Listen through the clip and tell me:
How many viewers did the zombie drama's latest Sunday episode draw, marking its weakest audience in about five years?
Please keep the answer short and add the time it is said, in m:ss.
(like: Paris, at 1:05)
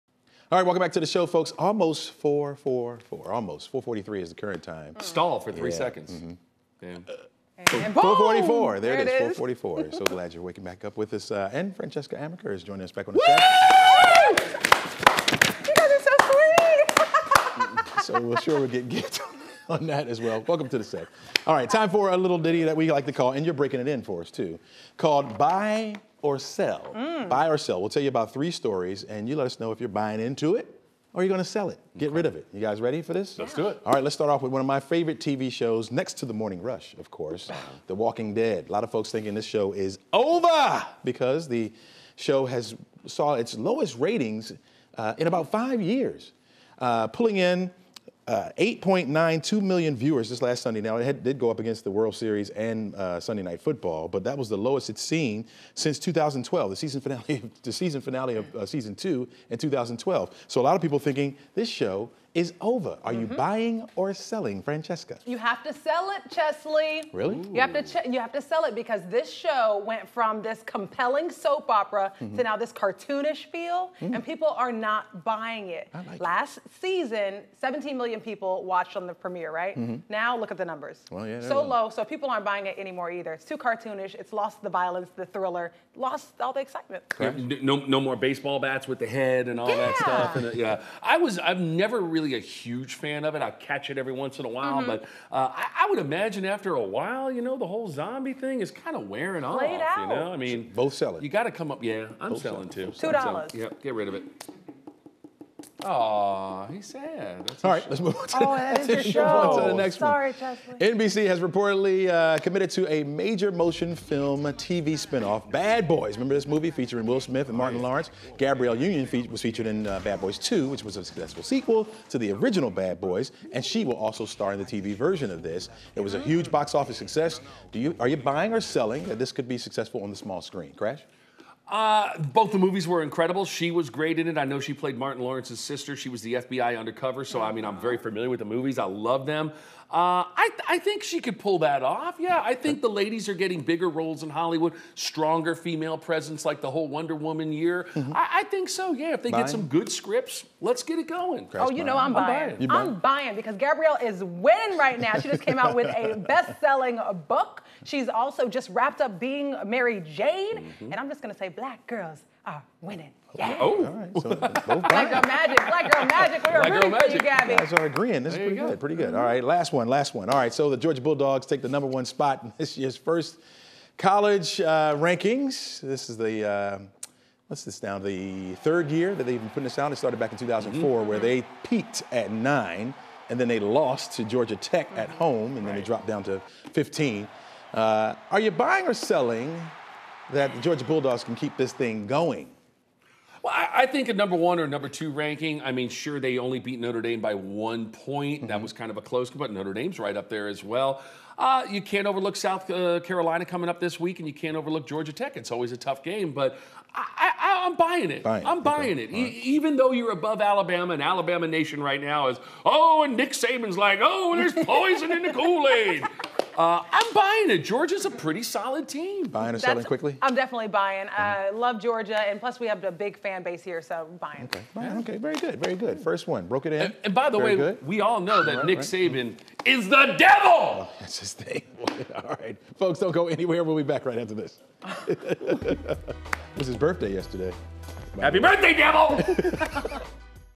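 8.92 million, at 0:48.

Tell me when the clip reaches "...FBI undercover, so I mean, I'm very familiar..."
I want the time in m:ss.
2:16.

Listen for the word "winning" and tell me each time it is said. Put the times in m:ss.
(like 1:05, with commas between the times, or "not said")
2:34, 2:42.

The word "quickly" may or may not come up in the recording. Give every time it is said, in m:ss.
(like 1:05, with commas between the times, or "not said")
3:39.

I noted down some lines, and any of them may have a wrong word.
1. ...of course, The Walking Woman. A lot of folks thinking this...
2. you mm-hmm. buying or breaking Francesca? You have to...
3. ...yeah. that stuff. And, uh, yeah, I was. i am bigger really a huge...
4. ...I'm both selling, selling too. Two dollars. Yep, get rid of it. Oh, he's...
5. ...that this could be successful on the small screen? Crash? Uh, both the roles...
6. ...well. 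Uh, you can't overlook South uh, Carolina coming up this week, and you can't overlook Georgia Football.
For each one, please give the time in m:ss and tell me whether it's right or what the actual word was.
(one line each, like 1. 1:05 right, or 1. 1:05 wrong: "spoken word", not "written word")
1. 0:36 wrong: "Dead", not "Woman"
2. 1:03 wrong: "selling", not "breaking"
3. 1:29 wrong: "never", not "bigger"
4. 1:42 right
5. 2:09 wrong: "movies", not "roles"
6. 3:20 wrong: "Tech", not "Football".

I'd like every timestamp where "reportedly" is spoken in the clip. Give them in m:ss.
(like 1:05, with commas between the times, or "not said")
1:51.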